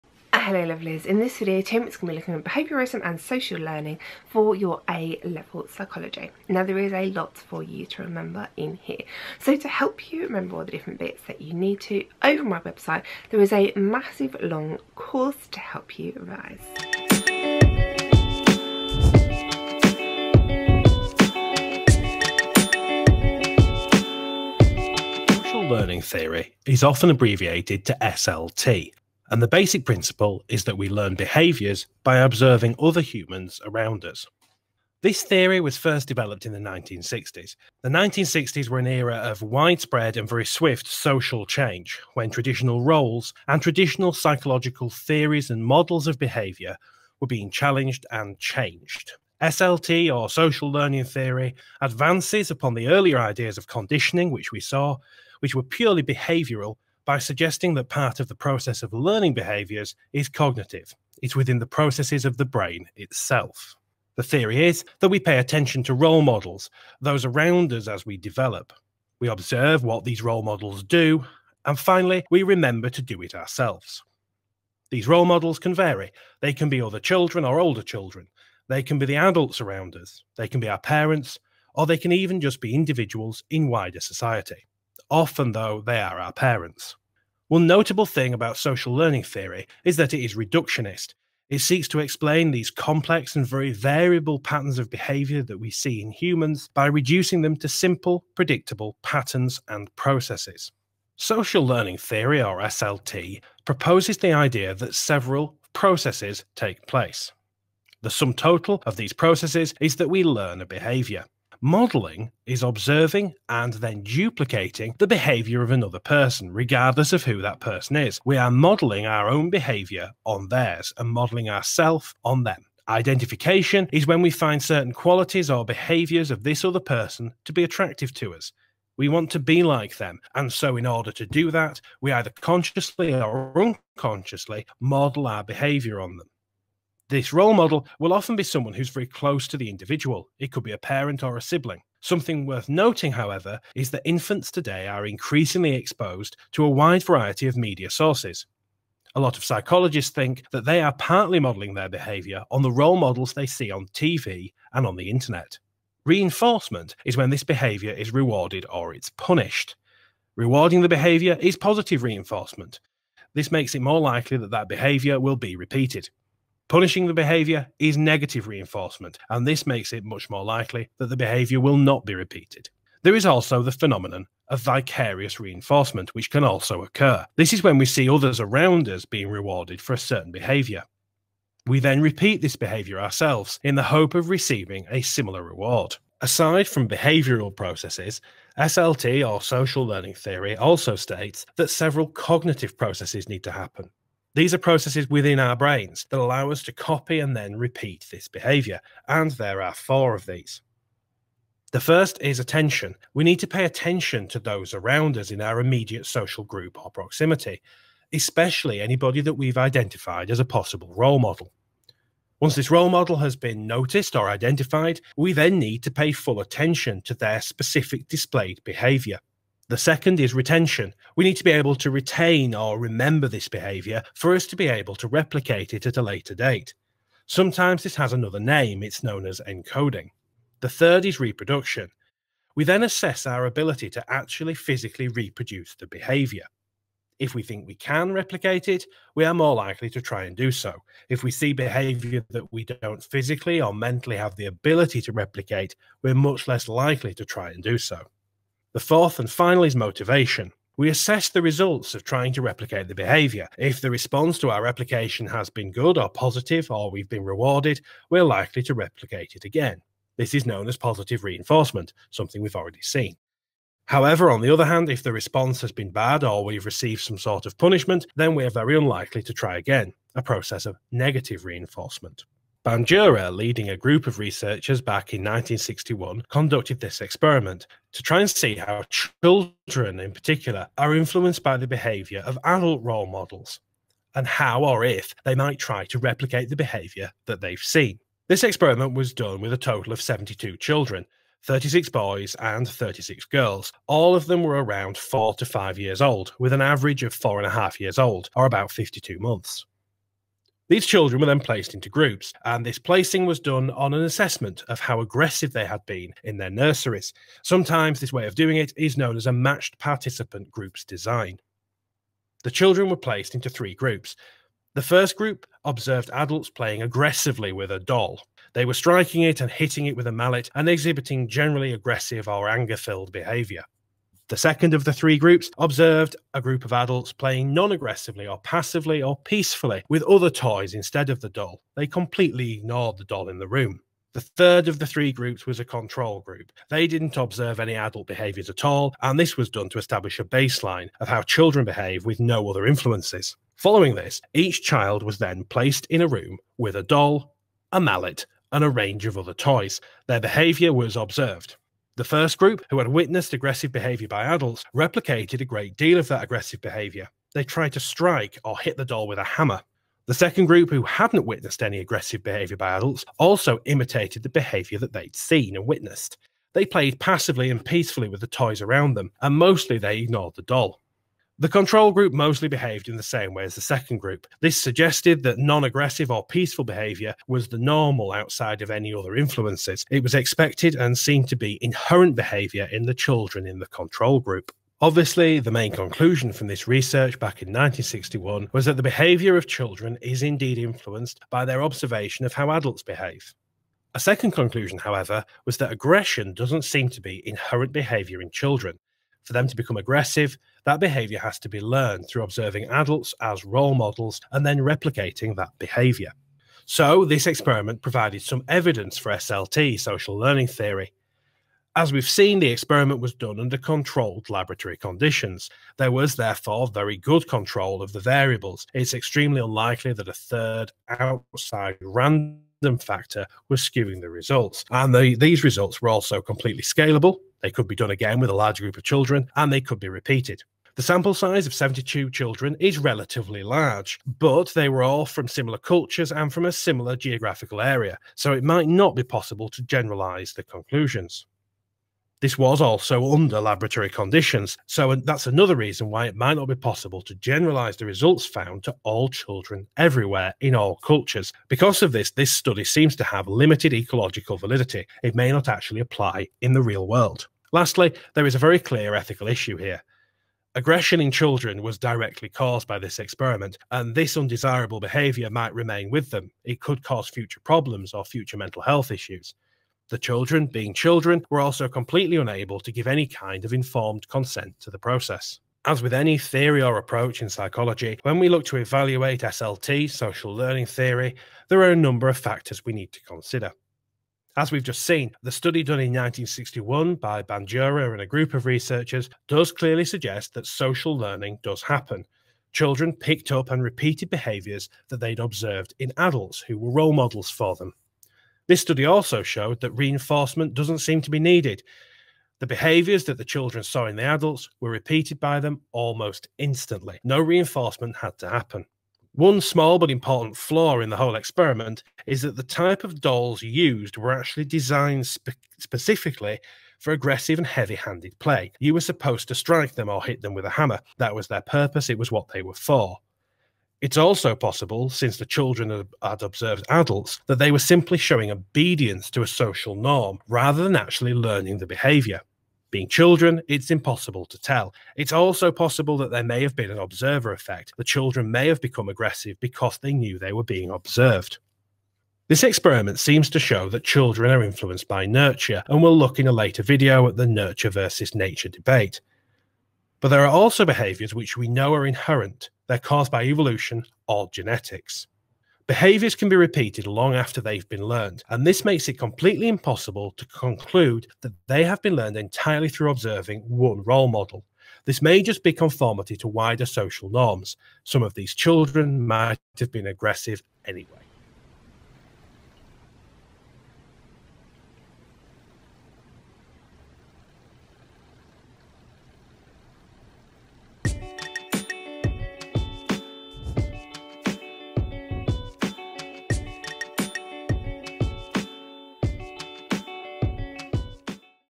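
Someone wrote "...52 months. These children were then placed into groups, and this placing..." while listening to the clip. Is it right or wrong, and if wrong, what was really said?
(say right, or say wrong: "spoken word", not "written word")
right.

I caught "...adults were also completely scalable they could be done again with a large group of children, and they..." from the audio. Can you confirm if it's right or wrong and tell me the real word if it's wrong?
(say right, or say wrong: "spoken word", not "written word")
wrong: "results", not "adults".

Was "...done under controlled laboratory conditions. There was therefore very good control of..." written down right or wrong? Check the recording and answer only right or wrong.
right.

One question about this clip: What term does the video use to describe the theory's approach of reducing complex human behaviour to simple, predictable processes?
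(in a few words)
reductionist.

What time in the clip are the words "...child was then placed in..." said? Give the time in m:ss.
5:44.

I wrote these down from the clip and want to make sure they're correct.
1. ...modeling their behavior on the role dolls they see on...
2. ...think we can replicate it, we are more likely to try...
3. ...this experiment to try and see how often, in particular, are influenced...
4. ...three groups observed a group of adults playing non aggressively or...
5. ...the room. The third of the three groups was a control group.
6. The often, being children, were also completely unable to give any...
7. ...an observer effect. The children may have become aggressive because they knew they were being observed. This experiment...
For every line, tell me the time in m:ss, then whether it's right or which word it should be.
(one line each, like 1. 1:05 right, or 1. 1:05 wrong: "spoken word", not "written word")
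1. 2:31 wrong: "models", not "dolls"
2. 3:57 right
3. 4:36 wrong: "children", not "often"
4. 5:24 right
5. 5:33 right
6. 7:49 wrong: "children", not "often"
7. 8:56 right.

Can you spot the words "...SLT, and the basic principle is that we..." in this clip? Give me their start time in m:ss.
0:28.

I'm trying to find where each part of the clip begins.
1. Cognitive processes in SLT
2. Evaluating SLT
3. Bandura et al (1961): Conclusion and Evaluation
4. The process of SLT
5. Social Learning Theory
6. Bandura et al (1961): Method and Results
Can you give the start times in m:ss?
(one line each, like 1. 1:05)
1. 3:06
2. 7:55
3. 6:24
4. 1:41
5. 0:25
6. 4:32.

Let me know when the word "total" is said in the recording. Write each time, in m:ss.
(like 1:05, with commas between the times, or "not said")
1:48, 4:49.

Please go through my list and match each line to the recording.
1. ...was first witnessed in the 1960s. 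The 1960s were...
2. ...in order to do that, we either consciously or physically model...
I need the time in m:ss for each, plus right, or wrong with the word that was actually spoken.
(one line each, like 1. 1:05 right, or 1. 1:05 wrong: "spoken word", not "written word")
1. 0:35 wrong: "developed", not "witnessed"
2. 2:10 wrong: "unconsciously", not "physically".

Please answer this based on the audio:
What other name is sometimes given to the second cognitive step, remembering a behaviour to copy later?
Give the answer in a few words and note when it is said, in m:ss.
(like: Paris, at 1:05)
encoding, at 3:49.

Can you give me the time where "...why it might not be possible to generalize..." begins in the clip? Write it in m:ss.
7:25.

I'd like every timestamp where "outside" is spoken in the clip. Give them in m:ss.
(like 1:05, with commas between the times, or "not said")
6:18, 7:00.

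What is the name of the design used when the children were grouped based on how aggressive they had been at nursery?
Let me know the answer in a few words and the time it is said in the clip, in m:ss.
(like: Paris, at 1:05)
matched participant groups design, at 5:09.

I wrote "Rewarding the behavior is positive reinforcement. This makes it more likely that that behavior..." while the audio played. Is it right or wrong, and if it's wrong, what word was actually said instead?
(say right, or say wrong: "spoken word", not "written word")
right.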